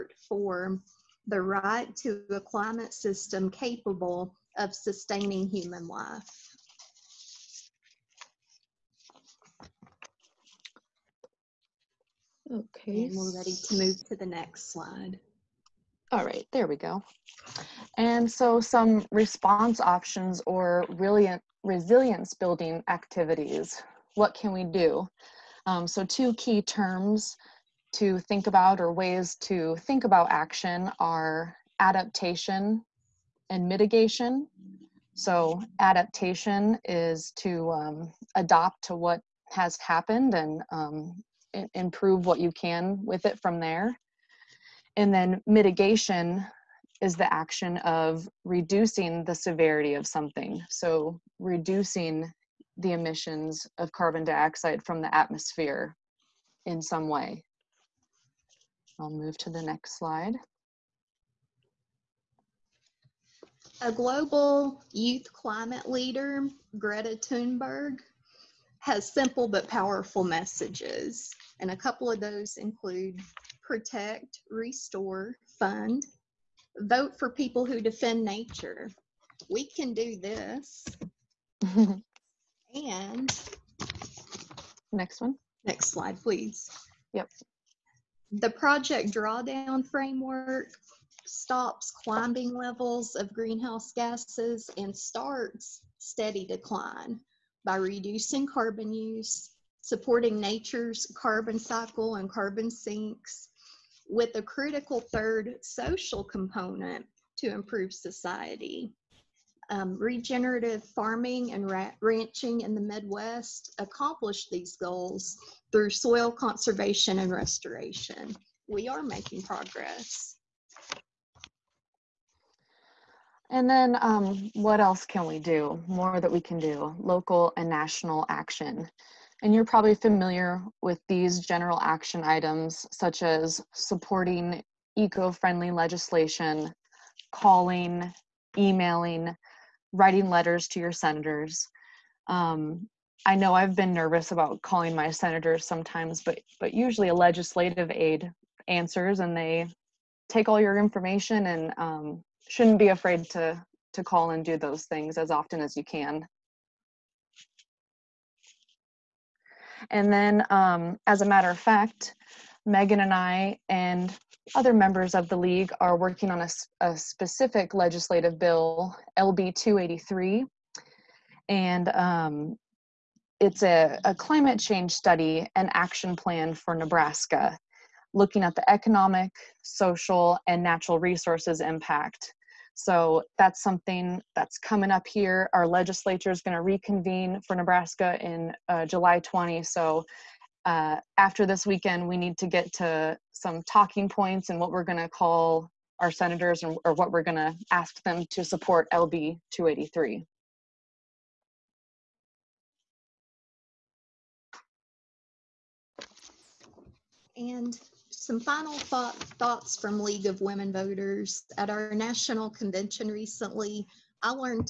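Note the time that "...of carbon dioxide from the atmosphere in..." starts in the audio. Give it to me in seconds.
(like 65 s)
53 s.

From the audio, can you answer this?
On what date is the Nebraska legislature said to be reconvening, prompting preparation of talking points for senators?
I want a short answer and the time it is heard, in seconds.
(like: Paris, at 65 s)
July 20, at 188 s.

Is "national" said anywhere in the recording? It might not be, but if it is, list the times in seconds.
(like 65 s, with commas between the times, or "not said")
127 s, 211 s.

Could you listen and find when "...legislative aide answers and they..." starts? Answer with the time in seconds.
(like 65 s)
147 s.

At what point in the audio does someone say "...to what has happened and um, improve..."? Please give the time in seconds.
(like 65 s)
38 s.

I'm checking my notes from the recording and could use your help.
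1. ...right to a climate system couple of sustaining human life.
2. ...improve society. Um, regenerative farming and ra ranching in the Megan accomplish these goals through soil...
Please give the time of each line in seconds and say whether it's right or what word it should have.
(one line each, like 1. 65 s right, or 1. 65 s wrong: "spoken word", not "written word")
1. 1 s wrong: "capable", not "couple"
2. 107 s wrong: "Midwest", not "Megan".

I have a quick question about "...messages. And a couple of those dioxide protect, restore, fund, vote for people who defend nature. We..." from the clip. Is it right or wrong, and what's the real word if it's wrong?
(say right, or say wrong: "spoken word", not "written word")
wrong: "include", not "dioxide".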